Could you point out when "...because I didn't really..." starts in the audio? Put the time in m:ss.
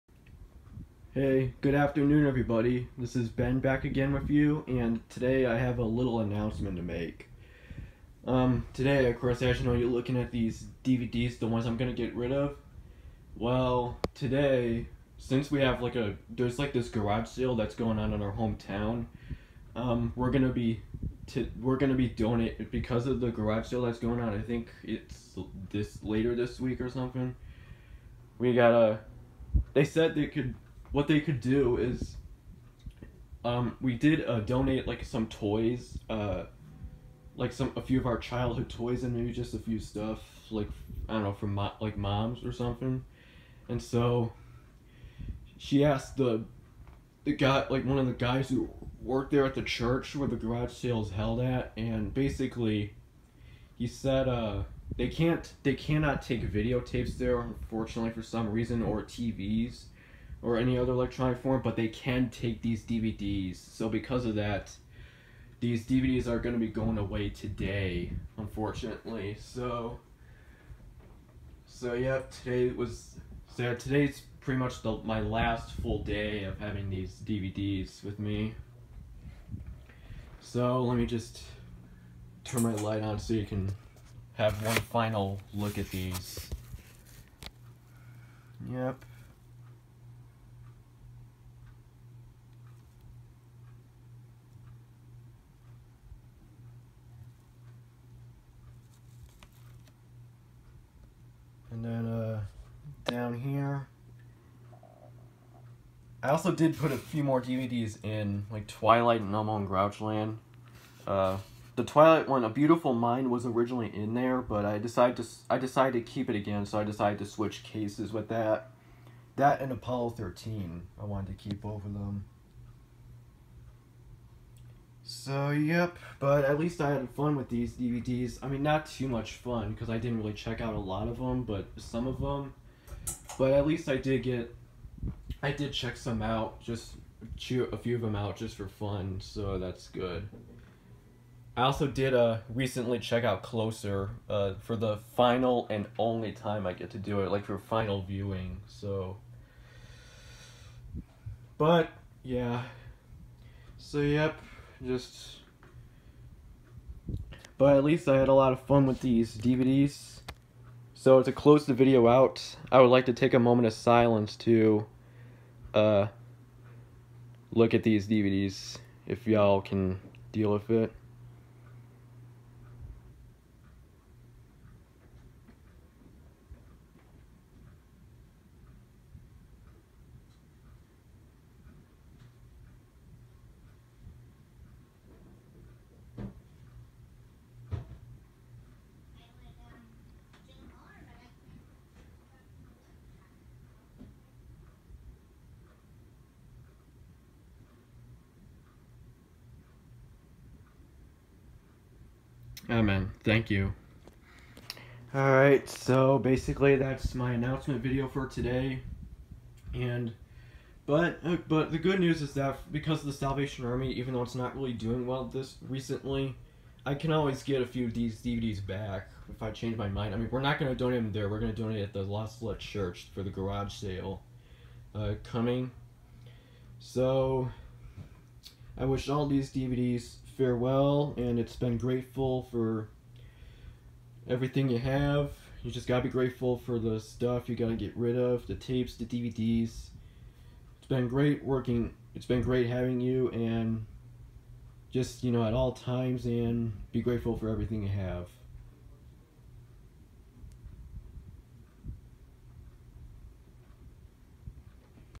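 2:09.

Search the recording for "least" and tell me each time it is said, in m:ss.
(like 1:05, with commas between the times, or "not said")
2:06, 2:13, 2:37.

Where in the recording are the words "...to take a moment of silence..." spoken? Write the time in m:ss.
2:43.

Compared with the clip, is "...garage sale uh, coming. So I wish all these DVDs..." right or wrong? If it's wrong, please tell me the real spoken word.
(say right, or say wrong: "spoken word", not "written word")
right.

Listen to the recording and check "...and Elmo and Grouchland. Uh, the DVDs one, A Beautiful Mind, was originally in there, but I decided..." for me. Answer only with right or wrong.
wrong.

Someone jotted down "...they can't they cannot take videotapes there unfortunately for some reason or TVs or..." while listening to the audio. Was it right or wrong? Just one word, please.
right.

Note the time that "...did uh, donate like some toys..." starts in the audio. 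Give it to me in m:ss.
0:33.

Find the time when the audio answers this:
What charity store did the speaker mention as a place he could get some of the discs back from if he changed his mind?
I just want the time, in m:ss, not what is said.
3:33.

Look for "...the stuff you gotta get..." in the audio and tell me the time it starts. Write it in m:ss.
3:56.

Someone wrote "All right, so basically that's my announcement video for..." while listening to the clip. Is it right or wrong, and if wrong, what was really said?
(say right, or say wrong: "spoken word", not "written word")
right.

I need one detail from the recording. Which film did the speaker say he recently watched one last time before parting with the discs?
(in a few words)
Closer.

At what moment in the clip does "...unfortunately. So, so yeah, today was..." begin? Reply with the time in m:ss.
1:08.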